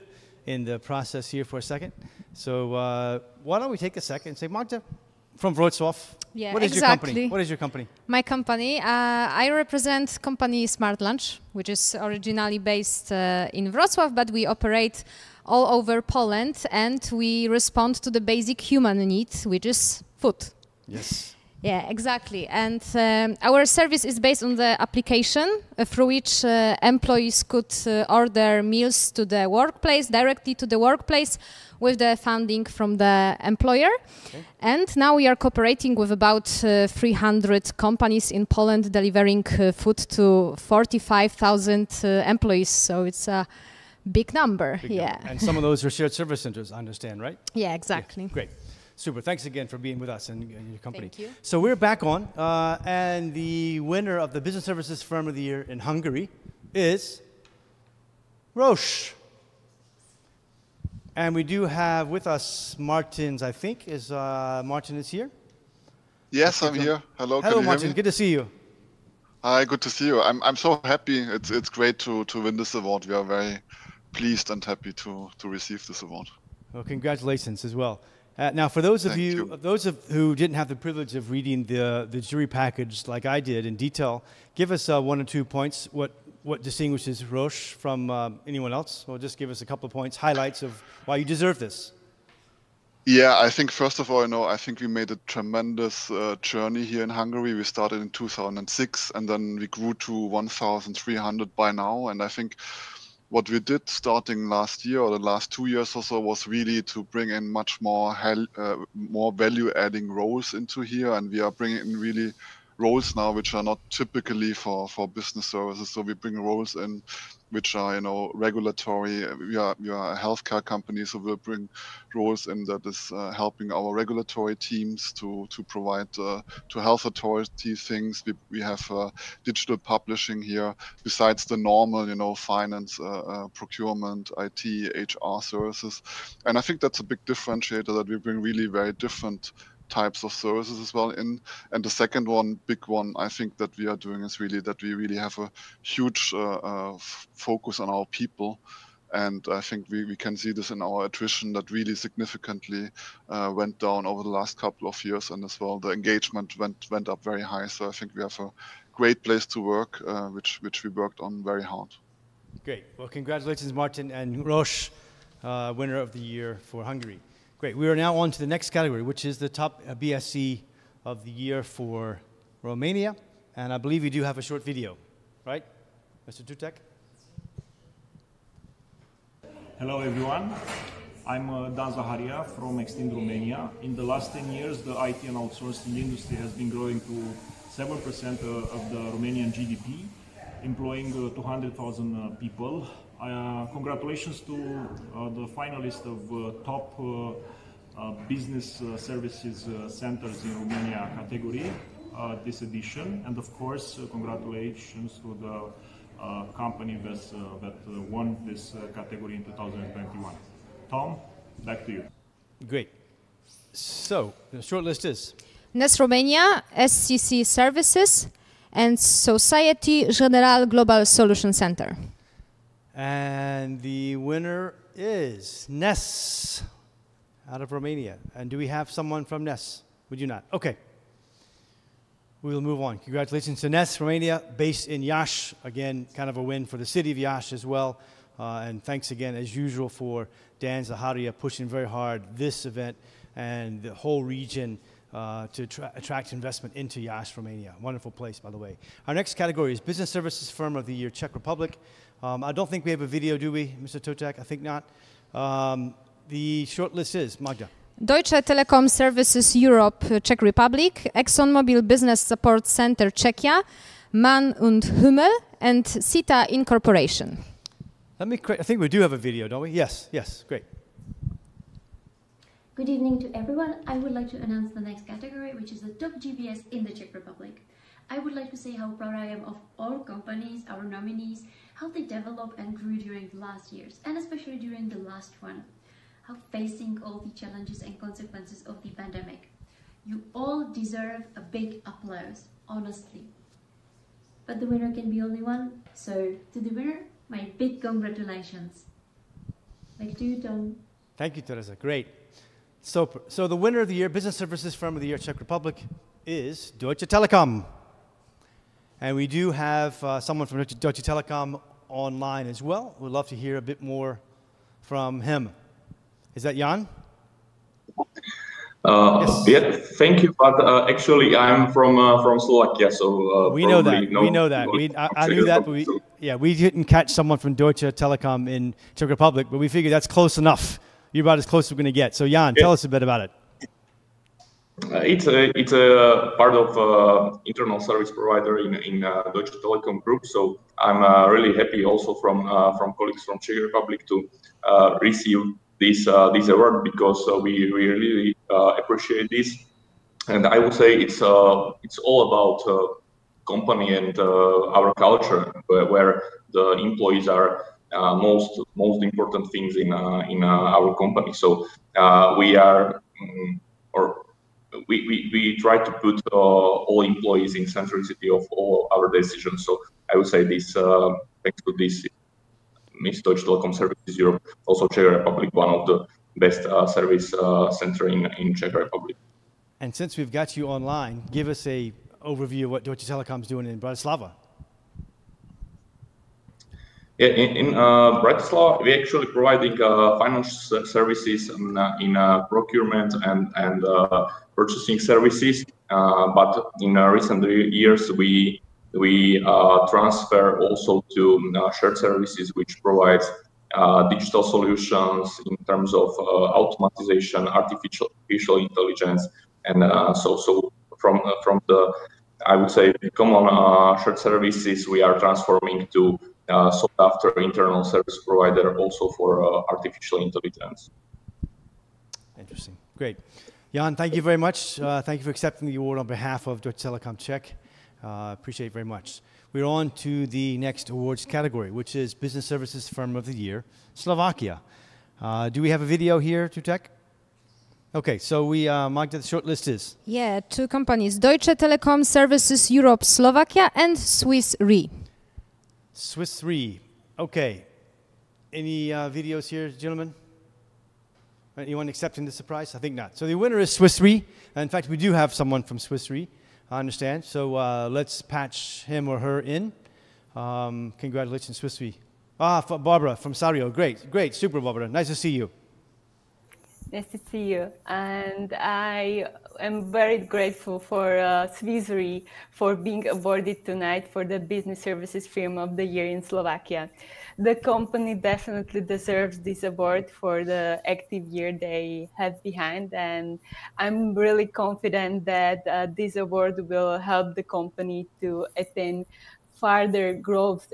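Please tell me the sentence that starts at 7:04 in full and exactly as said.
Uh, thank you for accepting the award on behalf of Deutsche Telekom Czech.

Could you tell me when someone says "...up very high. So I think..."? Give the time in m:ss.
2:37.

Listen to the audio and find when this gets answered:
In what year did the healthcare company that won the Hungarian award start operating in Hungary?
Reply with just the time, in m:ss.
1:38.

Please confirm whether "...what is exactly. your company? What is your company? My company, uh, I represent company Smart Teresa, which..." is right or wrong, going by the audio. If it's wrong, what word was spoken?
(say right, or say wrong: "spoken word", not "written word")
wrong: "Lunch", not "Teresa".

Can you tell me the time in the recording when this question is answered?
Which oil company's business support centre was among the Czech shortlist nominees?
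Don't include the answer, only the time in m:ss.
4:21.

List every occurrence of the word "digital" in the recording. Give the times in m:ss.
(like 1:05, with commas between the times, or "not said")
2:09, 6:44.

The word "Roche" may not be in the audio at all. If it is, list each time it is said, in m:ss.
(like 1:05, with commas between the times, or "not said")
0:58, 1:27, 2:44.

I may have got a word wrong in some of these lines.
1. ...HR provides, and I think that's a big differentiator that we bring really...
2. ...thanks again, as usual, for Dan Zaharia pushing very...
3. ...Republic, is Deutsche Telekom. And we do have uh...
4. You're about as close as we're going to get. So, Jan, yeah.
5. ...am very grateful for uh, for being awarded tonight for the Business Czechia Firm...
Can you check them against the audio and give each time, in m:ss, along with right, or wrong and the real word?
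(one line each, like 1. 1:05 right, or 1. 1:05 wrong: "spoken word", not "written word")
1. 2:15 wrong: "services", not "provides"
2. 3:58 right
3. 5:05 right
4. 5:31 right
5. 7:49 wrong: "Services", not "Czechia".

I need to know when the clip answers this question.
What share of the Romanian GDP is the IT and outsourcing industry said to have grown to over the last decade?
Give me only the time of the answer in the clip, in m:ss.
3:07.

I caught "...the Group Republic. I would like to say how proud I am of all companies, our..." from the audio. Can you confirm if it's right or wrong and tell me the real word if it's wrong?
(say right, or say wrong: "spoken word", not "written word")
wrong: "Czech", not "Group".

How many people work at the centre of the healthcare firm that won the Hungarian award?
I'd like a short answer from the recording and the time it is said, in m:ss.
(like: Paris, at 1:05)
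1,300, at 1:40.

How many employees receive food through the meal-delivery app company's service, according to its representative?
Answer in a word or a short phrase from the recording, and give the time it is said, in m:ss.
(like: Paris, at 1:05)
45,000, at 0:40.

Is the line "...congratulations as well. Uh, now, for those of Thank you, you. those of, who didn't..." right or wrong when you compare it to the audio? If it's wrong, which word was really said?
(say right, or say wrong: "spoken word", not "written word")
right.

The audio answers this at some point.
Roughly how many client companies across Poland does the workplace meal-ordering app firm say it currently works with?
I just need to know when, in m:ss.
0:36.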